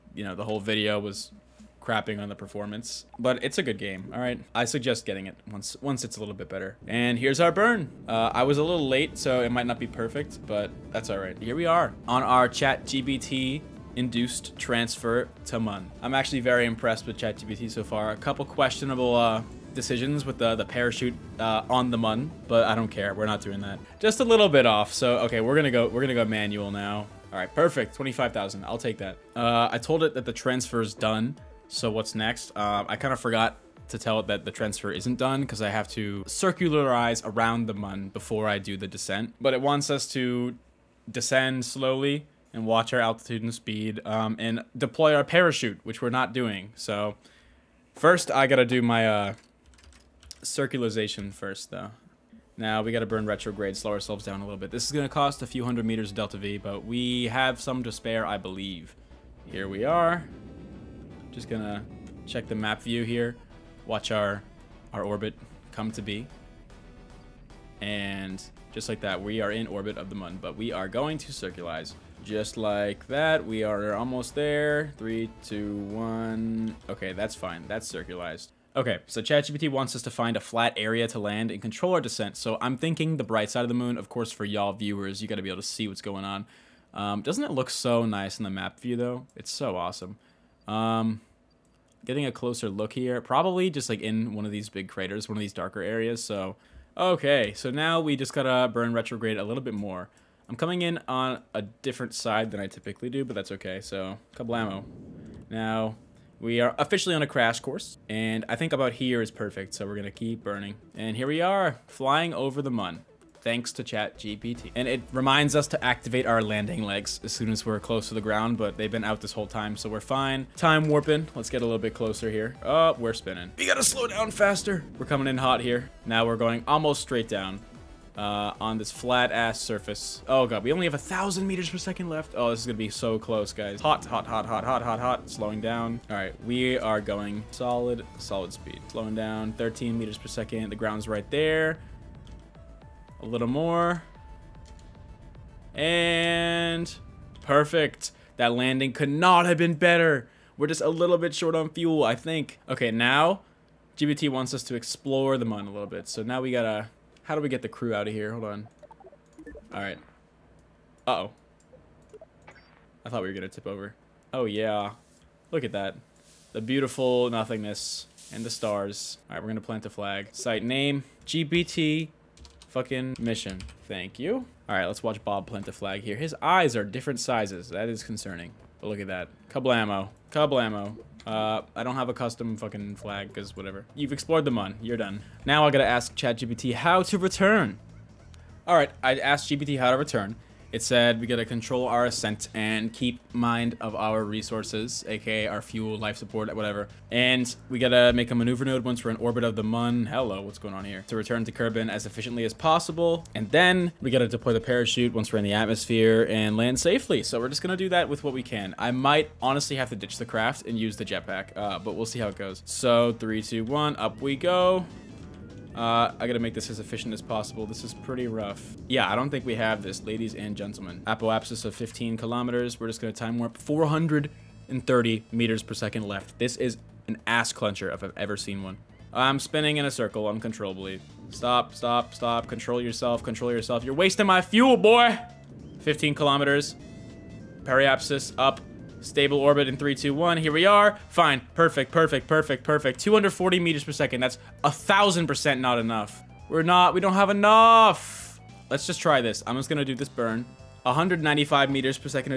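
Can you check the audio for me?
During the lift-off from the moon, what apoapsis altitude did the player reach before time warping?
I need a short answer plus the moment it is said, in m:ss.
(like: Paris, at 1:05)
15 kilometers, at 3:41.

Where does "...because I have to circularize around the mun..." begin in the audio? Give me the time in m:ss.
0:35.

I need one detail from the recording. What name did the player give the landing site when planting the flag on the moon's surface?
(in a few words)
GPT fucking mission.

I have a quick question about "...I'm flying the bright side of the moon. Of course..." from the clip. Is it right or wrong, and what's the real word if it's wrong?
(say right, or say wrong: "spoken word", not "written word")
wrong: "thinking", not "flying".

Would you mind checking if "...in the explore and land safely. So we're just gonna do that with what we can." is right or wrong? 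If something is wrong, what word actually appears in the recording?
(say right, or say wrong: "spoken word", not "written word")
wrong: "atmosphere", not "explore".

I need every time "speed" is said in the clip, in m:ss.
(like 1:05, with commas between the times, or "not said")
0:43, 2:18.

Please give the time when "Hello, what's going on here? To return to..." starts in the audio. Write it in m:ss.
3:20.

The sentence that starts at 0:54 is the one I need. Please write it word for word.
This is going to cost a few hundred meters delta V, but we have some to spare, I believe.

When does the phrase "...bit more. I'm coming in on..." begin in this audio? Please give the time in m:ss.
1:39.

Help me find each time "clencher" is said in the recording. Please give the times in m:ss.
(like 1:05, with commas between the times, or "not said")
3:47.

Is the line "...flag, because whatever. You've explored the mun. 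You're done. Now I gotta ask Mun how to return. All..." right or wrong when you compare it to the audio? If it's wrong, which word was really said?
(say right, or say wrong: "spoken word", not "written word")
wrong: "ChatGPT", not "Mun".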